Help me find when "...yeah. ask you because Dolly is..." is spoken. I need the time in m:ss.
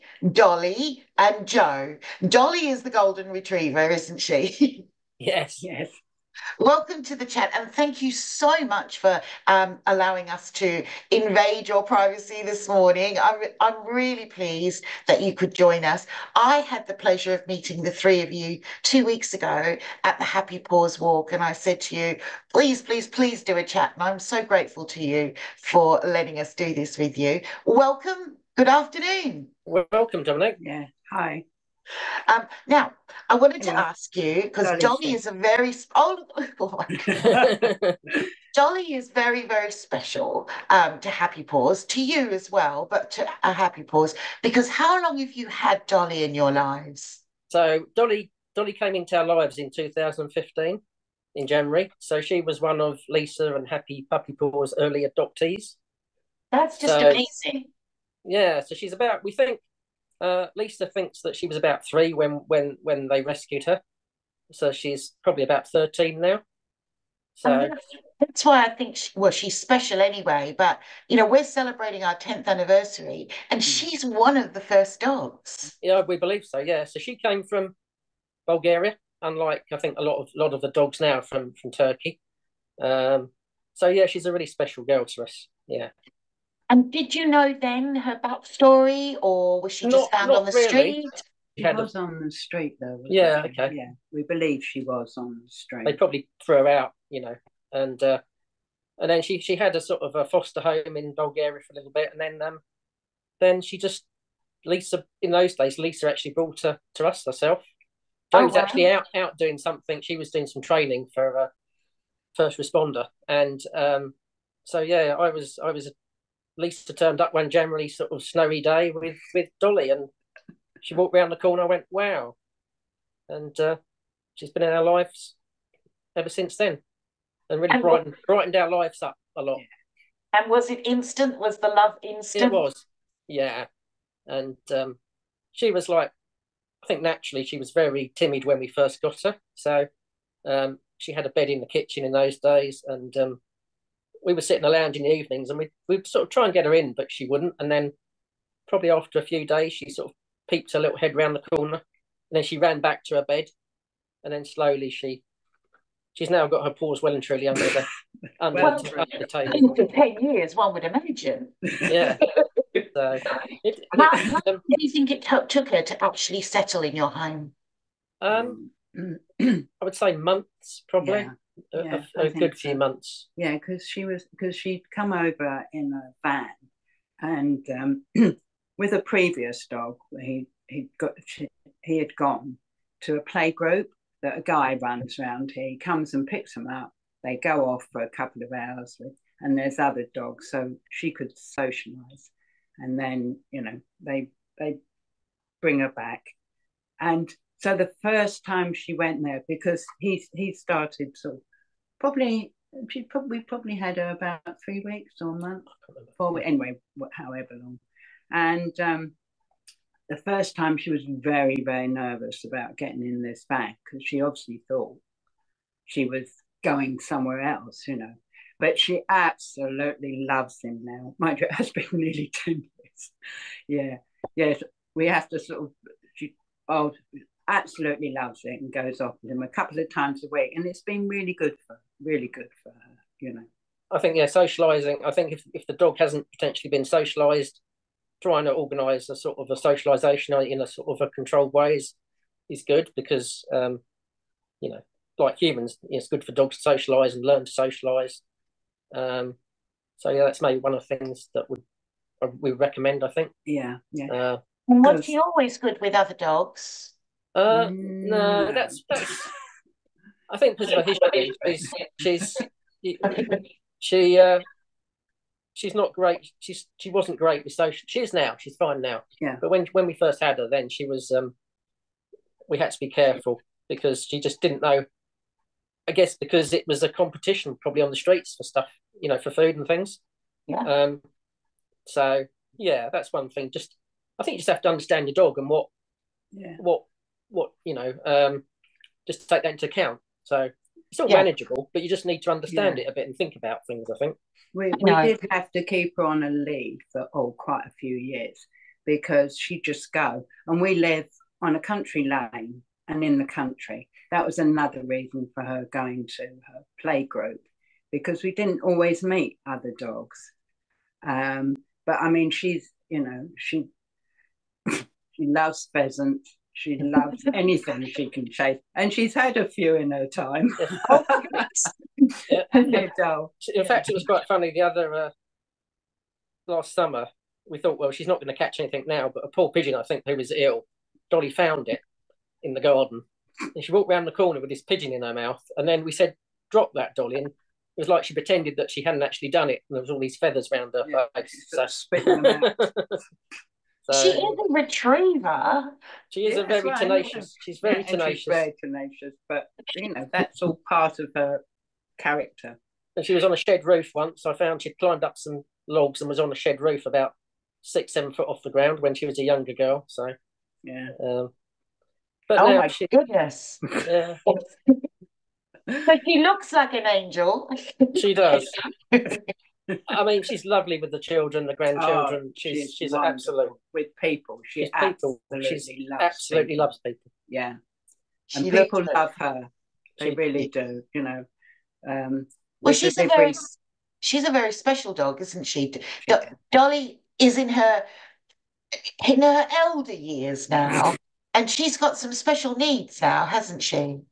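0:33.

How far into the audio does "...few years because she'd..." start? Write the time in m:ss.
4:57.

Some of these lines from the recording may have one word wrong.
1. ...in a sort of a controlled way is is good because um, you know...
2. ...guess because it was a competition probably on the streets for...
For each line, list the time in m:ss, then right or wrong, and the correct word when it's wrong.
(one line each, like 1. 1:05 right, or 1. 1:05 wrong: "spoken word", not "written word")
1. 4:00 right
2. 4:35 right.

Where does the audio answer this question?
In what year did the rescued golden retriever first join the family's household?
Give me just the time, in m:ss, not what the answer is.
0:49.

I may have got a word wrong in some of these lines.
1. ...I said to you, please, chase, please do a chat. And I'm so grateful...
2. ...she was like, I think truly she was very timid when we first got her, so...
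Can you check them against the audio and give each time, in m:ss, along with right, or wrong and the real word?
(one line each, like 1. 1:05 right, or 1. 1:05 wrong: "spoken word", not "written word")
1. 0:21 wrong: "please", not "chase"
2. 2:15 wrong: "naturally", not "truly".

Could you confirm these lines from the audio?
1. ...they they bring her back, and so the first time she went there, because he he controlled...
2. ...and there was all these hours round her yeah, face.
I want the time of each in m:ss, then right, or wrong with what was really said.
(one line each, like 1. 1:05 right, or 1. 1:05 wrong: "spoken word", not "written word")
1. 3:14 wrong: "started", not "controlled"
2. 5:39 wrong: "feathers", not "hours".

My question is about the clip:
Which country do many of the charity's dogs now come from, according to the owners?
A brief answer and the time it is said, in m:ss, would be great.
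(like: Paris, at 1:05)
Turkey, at 1:21.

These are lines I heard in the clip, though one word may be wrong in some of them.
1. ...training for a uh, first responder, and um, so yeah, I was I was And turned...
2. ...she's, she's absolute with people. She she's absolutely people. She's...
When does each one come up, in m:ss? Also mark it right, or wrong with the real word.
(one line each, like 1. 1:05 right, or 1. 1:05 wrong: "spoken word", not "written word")
1. 1:50 wrong: "Lisa", not "And"
2. 6:12 right.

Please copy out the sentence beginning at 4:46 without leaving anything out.
what what you know, um, just take that into account.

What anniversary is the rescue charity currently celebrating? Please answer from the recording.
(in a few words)
tenth.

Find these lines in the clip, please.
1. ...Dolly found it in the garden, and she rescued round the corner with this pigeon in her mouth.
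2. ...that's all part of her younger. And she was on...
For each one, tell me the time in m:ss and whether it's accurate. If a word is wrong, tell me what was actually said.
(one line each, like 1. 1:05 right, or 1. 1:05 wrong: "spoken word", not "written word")
1. 5:31 wrong: "walked", not "rescued"
2. 5:50 wrong: "character", not "younger".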